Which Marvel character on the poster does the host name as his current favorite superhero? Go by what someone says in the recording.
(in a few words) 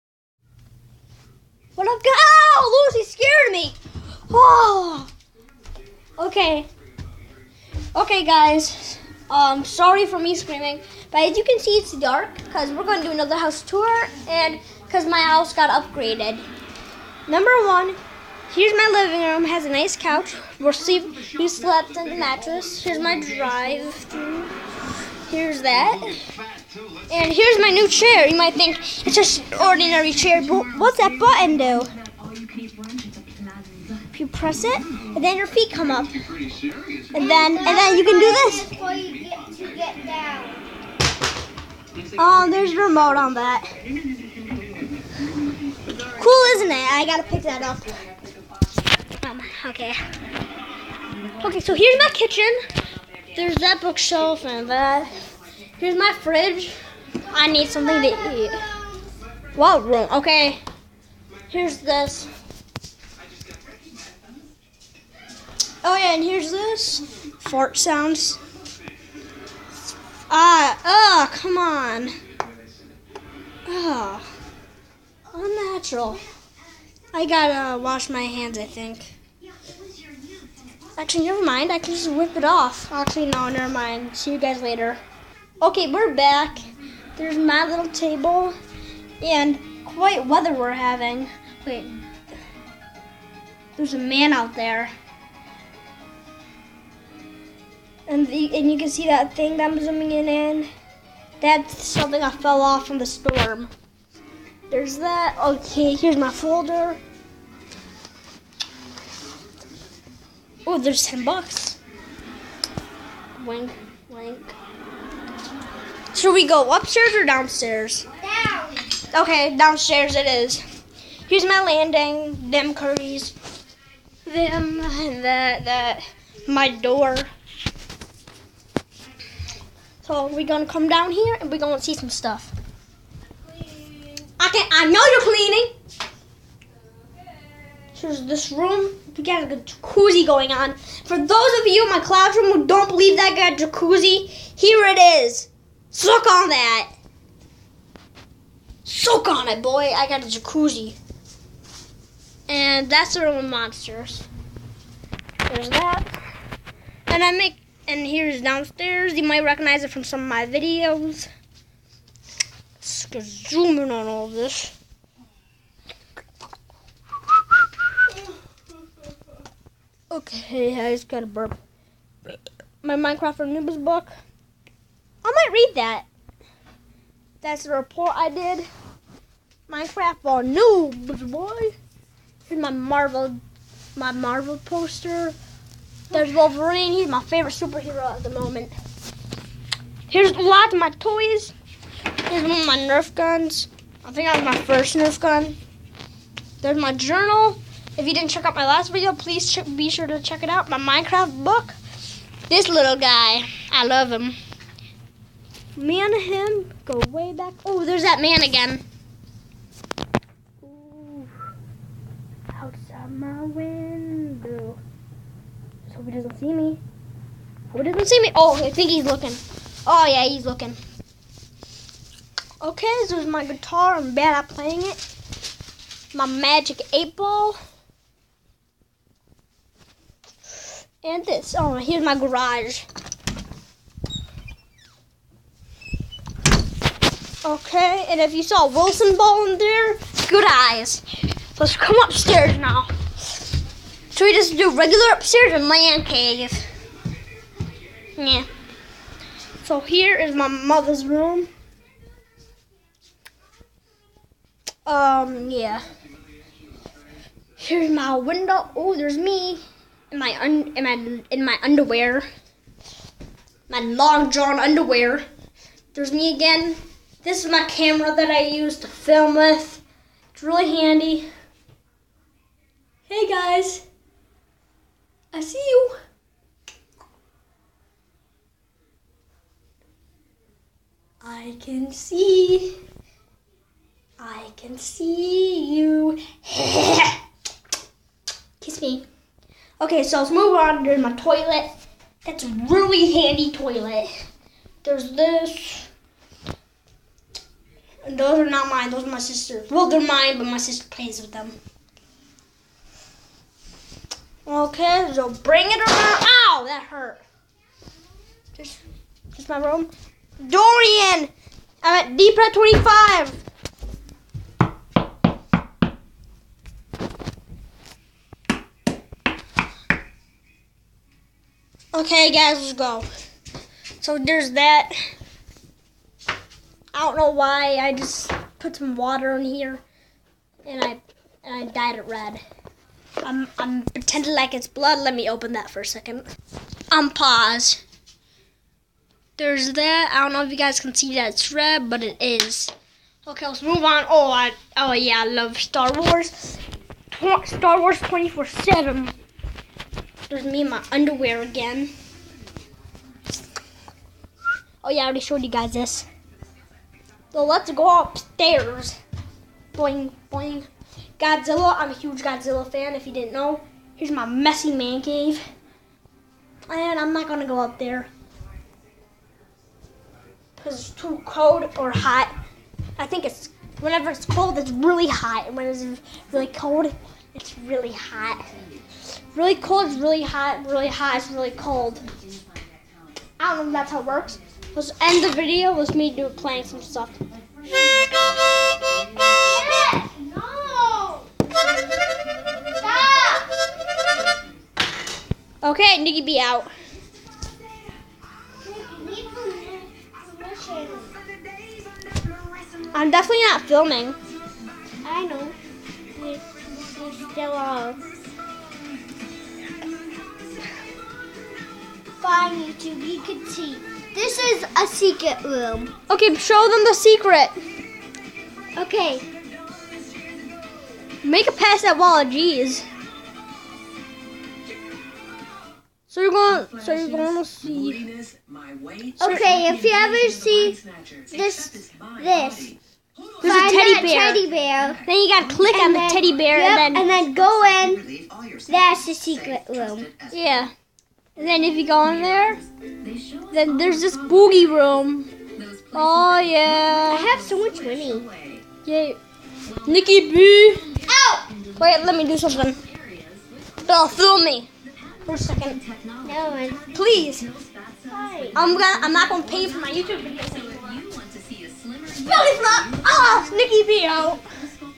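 Wolverine.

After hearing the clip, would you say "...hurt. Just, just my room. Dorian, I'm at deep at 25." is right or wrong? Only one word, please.
right.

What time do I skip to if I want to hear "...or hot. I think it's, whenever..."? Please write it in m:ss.
6:11.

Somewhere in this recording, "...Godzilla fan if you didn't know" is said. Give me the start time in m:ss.
6:02.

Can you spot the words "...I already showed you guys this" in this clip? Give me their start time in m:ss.
5:55.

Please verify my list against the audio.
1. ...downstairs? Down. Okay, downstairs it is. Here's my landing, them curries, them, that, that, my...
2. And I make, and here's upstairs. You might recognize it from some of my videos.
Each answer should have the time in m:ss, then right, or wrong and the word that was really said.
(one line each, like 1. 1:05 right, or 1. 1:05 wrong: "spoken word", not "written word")
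1. 1:57 right
2. 2:37 wrong: "downstairs", not "upstairs".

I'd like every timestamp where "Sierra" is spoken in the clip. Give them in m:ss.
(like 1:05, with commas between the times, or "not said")
not said.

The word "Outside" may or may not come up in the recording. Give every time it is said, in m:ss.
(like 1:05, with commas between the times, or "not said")
3:32.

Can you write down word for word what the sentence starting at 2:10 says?
So we're gonna come down here and we're gonna see some stuff.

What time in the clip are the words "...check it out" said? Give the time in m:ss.
3:20.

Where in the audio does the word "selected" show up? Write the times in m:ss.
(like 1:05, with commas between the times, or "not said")
not said.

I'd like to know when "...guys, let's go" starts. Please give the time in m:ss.
5:22.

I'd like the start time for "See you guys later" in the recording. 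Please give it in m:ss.
1:24.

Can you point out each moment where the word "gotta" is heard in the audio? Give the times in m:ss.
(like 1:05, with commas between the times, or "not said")
0:47, 1:17, 7:15.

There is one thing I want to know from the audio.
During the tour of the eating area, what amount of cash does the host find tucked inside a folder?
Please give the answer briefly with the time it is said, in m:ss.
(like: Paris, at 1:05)
$10, at 1:51.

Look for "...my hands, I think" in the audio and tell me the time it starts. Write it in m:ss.
1:18.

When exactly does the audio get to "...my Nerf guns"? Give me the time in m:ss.
3:12.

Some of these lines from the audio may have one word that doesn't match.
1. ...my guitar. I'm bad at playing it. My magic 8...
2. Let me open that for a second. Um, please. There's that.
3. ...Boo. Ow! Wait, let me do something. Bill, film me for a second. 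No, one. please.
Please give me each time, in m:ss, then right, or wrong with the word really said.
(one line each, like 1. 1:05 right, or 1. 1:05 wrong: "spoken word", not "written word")
1. 3:43 right
2. 5:34 wrong: "pause", not "please"
3. 7:30 right.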